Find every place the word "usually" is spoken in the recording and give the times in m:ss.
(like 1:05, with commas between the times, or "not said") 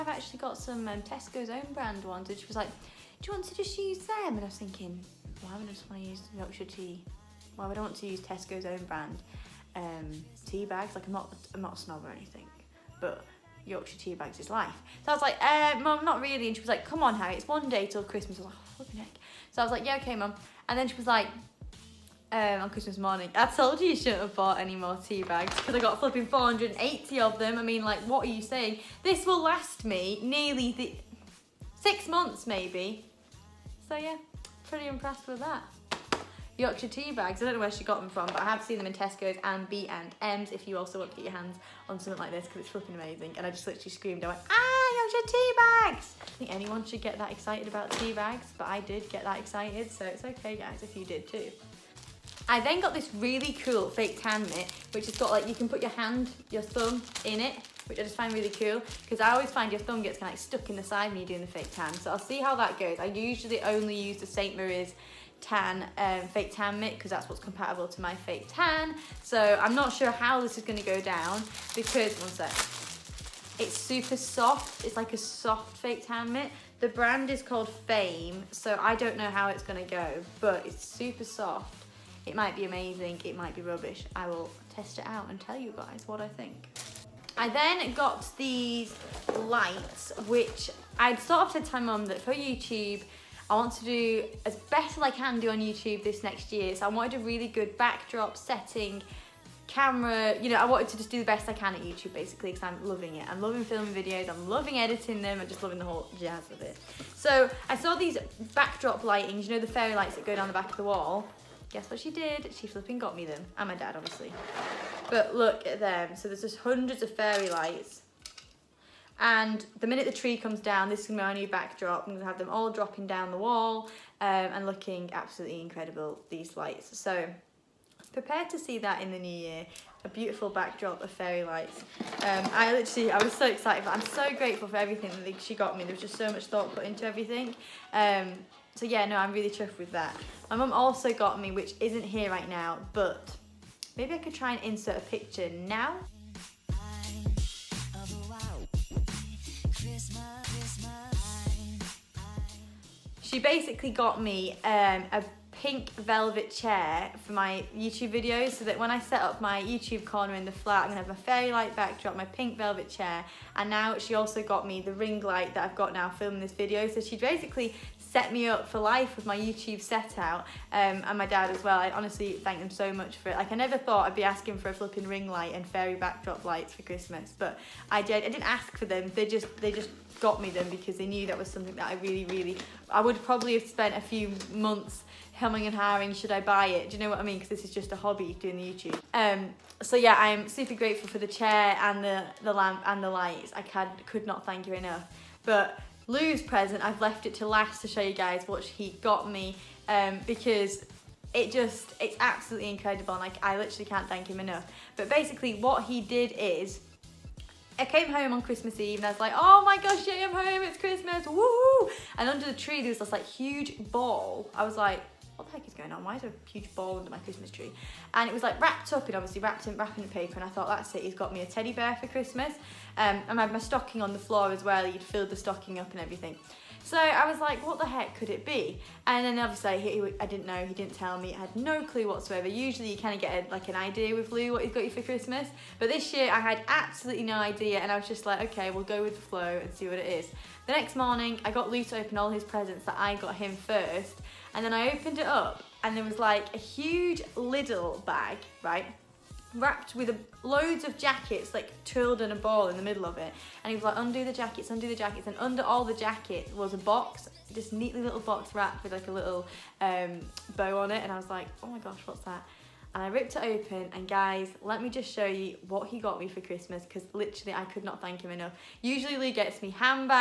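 1:03, 3:52, 4:28.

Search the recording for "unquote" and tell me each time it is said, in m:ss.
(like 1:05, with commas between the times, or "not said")
not said.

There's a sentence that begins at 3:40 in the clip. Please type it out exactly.
And I thought, that's it, he's got me a teddy bear for Christmas.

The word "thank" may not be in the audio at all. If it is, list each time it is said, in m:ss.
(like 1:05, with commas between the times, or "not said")
2:52, 3:14, 3:24, 4:28.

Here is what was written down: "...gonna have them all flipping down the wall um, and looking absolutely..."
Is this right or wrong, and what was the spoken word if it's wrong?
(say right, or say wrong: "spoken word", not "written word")
wrong: "dropping", not "flipping".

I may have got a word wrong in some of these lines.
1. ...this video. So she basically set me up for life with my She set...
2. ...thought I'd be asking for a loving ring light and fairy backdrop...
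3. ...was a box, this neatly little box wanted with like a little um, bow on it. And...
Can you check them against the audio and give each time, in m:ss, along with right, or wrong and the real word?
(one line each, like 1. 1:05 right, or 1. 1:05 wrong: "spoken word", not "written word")
1. 2:46 wrong: "YouTube", not "She"
2. 2:53 wrong: "flipping", not "loving"
3. 4:16 wrong: "wrapped", not "wanted".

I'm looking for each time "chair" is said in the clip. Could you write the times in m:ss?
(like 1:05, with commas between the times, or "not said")
2:36, 2:42, 3:11.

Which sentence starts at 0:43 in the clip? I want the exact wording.
And I just literally screamed, I went, ah, Yorkshire tea bags!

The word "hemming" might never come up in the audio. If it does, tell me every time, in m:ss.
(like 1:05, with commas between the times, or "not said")
3:05.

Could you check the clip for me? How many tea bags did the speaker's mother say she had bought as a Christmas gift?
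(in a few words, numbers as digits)
480.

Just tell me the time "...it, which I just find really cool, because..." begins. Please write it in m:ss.
0:57.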